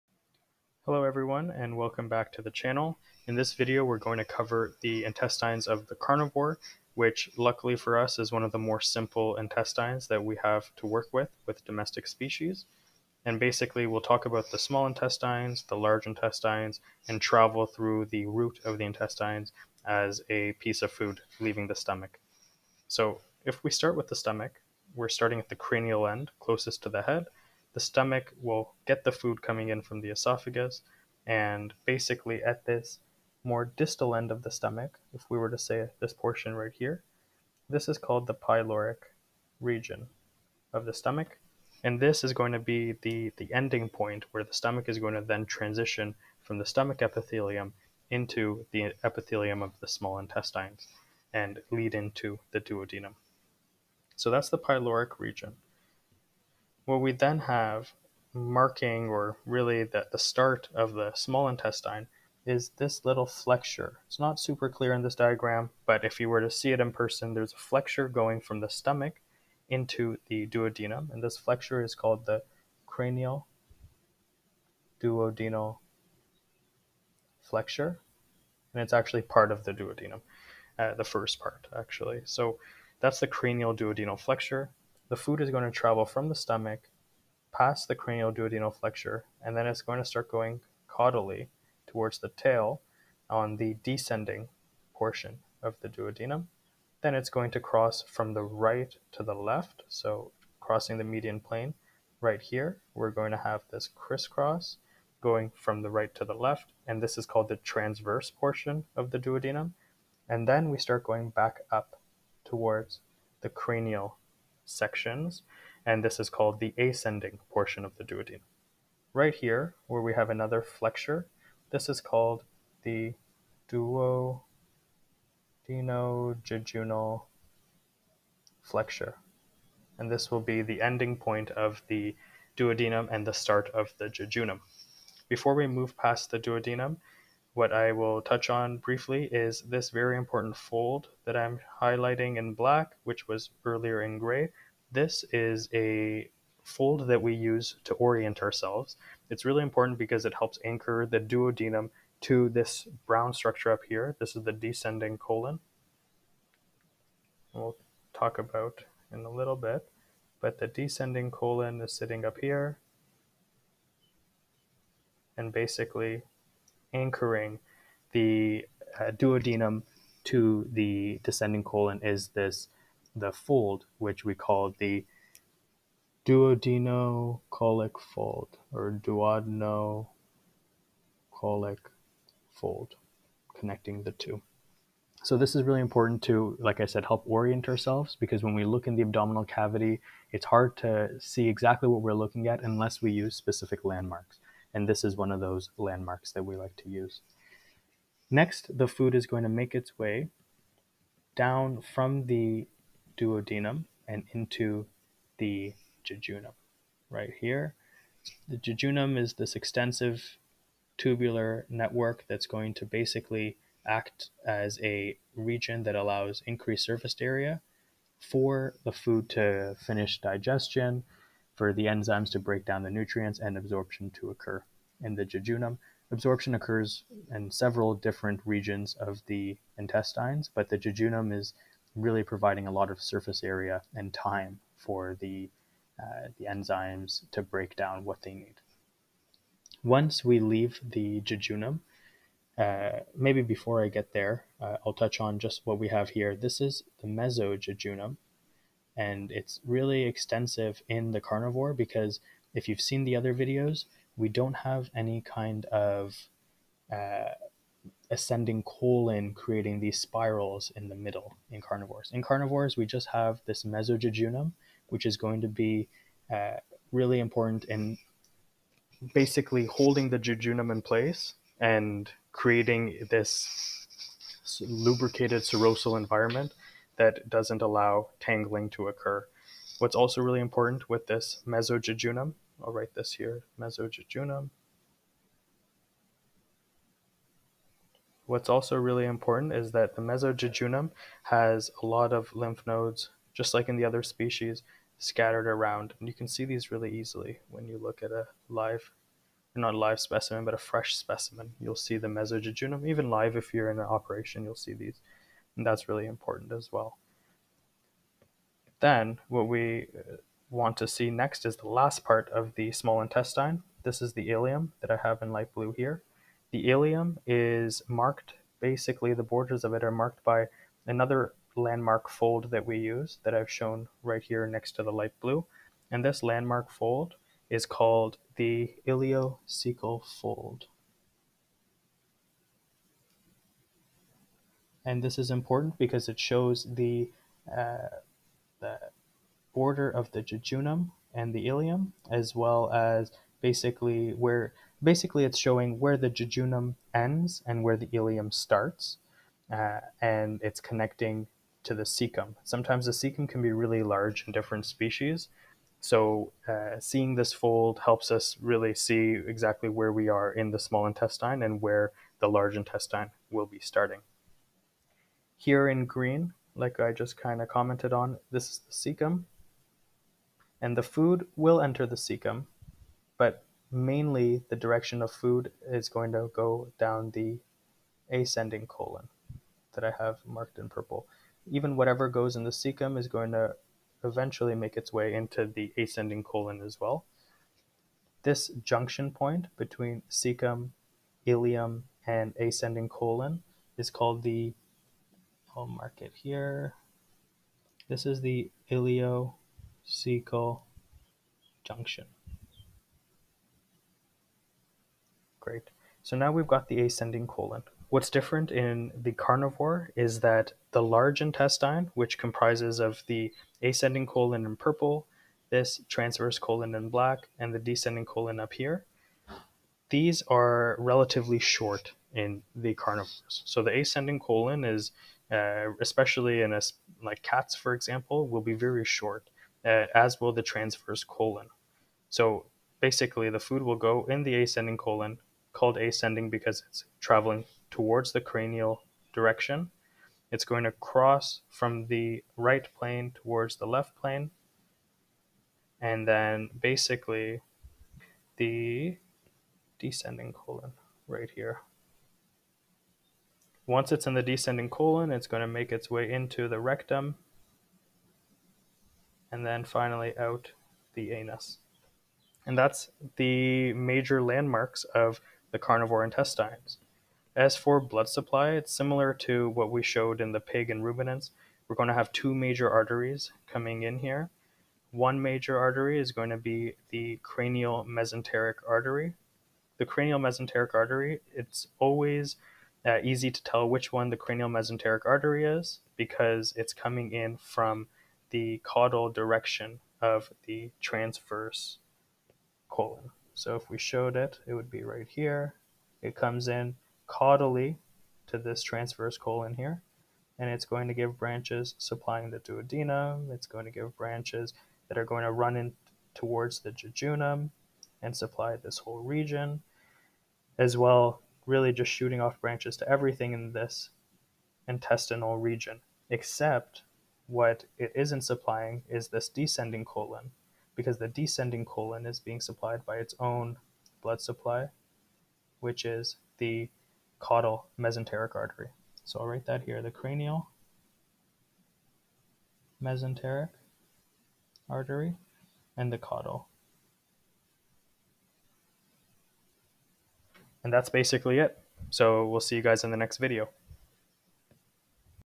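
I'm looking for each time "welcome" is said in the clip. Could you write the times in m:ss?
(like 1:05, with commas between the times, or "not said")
0:01.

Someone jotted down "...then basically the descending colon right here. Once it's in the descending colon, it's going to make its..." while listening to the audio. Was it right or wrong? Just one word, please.
right.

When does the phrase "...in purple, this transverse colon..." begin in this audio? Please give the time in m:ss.
6:54.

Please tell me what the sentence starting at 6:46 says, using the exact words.
So now we've got the ascending colon.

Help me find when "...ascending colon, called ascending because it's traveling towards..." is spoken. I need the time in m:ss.
7:14.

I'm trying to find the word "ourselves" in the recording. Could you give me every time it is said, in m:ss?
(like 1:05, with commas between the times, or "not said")
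2:28, 3:07.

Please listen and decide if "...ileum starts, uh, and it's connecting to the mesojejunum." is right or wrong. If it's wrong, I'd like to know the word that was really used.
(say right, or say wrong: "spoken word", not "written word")
wrong: "cecum", not "mesojejunum".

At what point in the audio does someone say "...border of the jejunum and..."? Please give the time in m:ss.
5:39.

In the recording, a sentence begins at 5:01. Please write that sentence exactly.
You'll see the mesojejunum, even live if you're in an operation, you'll see these.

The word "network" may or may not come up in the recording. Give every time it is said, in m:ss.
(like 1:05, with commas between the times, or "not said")
3:31.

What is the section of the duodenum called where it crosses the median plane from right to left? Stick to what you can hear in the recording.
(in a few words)
transverse portion.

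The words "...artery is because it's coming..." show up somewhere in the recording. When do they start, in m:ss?
8:05.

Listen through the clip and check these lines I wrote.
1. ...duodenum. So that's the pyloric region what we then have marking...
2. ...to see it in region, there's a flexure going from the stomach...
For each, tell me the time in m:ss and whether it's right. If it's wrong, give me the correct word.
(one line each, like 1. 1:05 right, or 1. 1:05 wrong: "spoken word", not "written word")
1. 0:52 right
2. 1:06 wrong: "person", not "region".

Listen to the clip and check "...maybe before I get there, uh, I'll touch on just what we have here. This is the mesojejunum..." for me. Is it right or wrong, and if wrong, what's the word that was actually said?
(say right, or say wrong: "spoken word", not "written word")
right.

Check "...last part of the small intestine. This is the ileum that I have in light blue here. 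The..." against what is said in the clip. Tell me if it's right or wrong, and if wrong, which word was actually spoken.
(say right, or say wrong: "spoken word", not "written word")
right.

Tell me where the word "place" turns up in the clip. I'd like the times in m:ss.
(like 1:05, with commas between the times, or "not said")
4:30.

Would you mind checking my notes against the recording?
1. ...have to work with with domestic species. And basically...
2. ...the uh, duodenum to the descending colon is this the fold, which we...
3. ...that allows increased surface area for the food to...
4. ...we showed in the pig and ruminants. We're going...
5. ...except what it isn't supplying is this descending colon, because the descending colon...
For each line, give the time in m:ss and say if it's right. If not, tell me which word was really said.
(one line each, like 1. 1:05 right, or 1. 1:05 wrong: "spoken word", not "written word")
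1. 0:10 right
2. 2:48 right
3. 3:35 right
4. 7:49 right
5. 8:36 right.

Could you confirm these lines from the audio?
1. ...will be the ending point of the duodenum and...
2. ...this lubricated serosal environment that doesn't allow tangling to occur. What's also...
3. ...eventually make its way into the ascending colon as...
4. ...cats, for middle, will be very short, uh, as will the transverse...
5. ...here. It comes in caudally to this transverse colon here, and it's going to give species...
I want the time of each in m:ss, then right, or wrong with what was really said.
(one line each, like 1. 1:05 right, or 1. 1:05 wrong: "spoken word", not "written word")
1. 2:10 right
2. 4:33 right
3. 6:24 right
4. 7:07 wrong: "example", not "middle"
5. 8:15 wrong: "branches", not "species".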